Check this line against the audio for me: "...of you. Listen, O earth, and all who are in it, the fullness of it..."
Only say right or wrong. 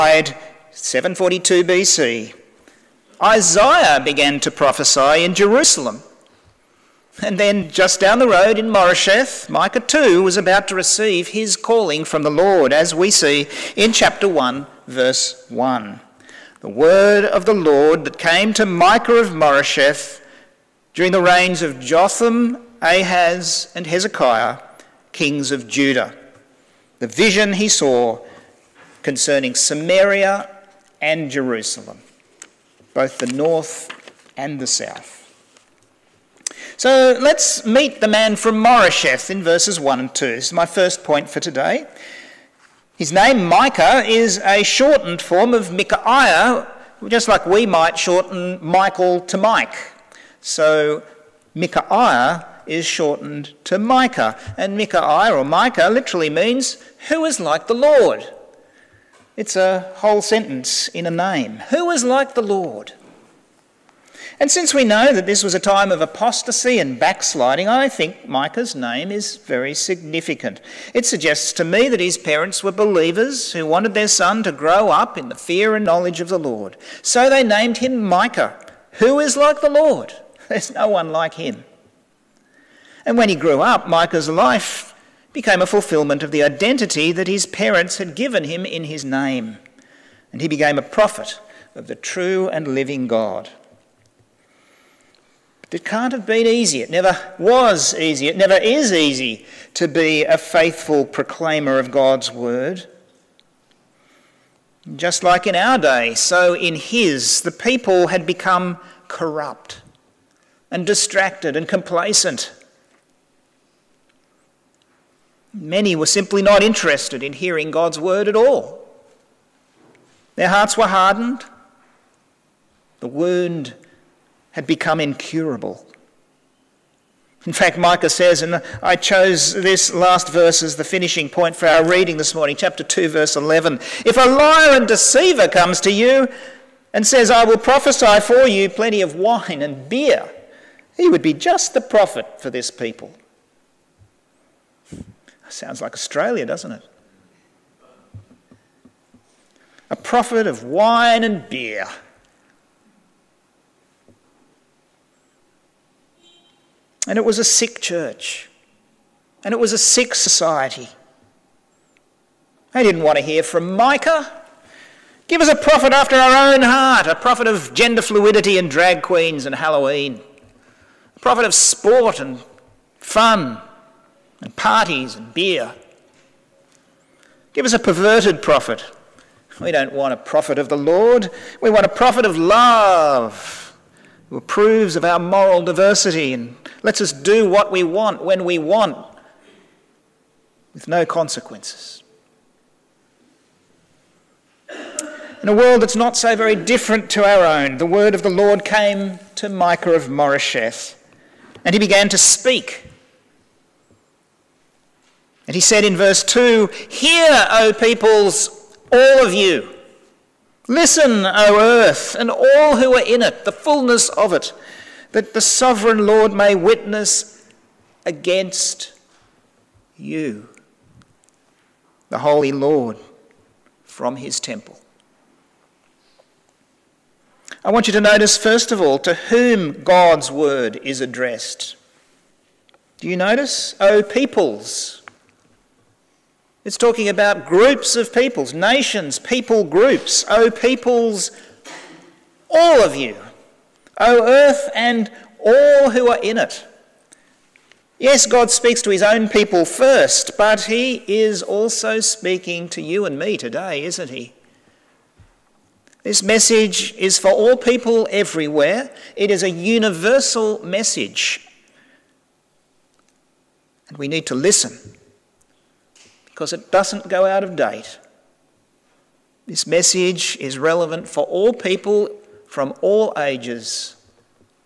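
right.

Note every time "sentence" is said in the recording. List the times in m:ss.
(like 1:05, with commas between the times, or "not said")
1:00.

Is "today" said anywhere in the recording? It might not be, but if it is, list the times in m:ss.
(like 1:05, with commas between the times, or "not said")
0:41, 4:13.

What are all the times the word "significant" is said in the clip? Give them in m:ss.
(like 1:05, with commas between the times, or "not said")
1:09.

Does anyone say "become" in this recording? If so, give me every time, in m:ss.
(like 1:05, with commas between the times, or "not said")
1:48, 2:04.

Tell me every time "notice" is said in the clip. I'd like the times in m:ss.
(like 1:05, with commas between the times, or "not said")
3:48, 3:53.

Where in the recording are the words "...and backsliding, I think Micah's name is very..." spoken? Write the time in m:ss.
1:06.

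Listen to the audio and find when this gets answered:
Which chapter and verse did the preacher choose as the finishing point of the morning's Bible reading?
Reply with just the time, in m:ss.
2:12.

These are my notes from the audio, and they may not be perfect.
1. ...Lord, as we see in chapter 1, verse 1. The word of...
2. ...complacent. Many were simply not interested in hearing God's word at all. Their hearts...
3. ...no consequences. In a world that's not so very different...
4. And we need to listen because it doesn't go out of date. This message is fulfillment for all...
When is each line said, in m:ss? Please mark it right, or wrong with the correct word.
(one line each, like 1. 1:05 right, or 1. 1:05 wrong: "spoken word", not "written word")
1. 0:12 right
2. 1:51 right
3. 3:10 right
4. 4:23 wrong: "relevant", not "fulfillment".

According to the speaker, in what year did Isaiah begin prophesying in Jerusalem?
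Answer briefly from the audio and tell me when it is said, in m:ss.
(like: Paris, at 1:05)
742 BC, at 0:00.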